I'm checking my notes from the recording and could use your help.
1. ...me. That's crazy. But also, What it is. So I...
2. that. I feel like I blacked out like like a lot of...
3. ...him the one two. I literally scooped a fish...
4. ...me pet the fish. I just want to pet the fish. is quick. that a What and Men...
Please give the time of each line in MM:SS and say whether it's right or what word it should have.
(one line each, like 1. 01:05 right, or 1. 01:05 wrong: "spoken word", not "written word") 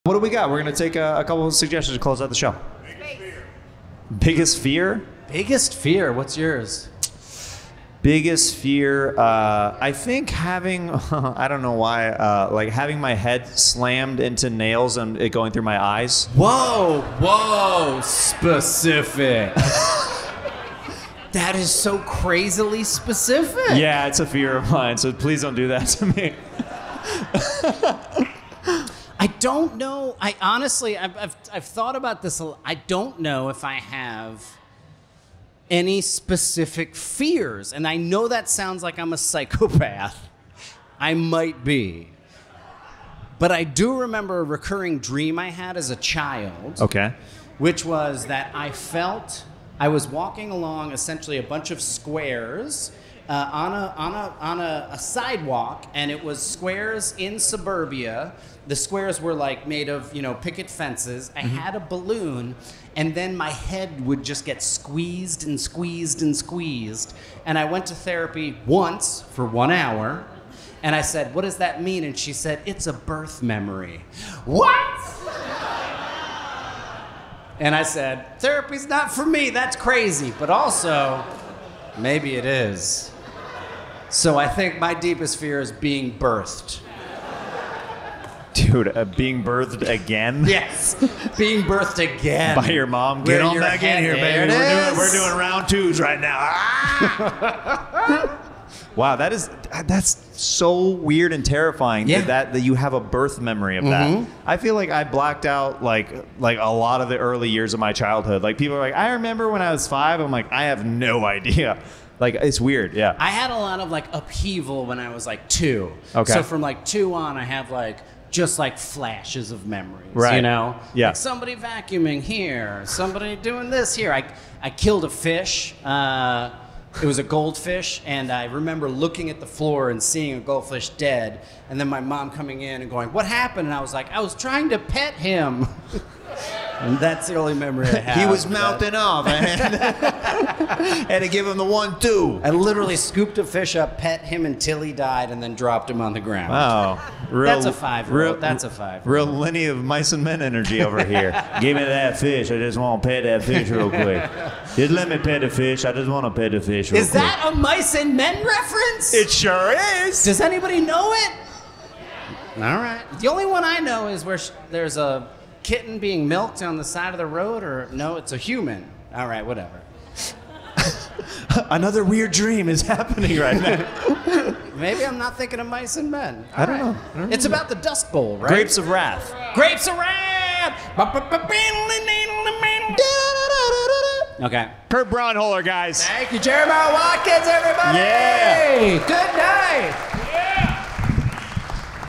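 1. 01:19 wrong: "Maybe", not "What"
2. 01:44 right
3. 02:21 right
4. 02:35 wrong: "Mice", not "What".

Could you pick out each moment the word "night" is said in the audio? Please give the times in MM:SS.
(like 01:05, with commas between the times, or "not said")
03:09.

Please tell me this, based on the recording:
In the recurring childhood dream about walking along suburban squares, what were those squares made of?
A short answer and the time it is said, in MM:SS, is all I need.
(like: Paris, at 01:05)
Picket fences, at 01:00.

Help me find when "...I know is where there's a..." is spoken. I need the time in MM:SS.
02:43.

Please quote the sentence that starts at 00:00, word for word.
We're going to take a, a couple of suggestions to close out the show.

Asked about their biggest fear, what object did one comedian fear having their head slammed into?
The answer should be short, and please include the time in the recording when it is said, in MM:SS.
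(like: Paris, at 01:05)
Nails, at 00:14.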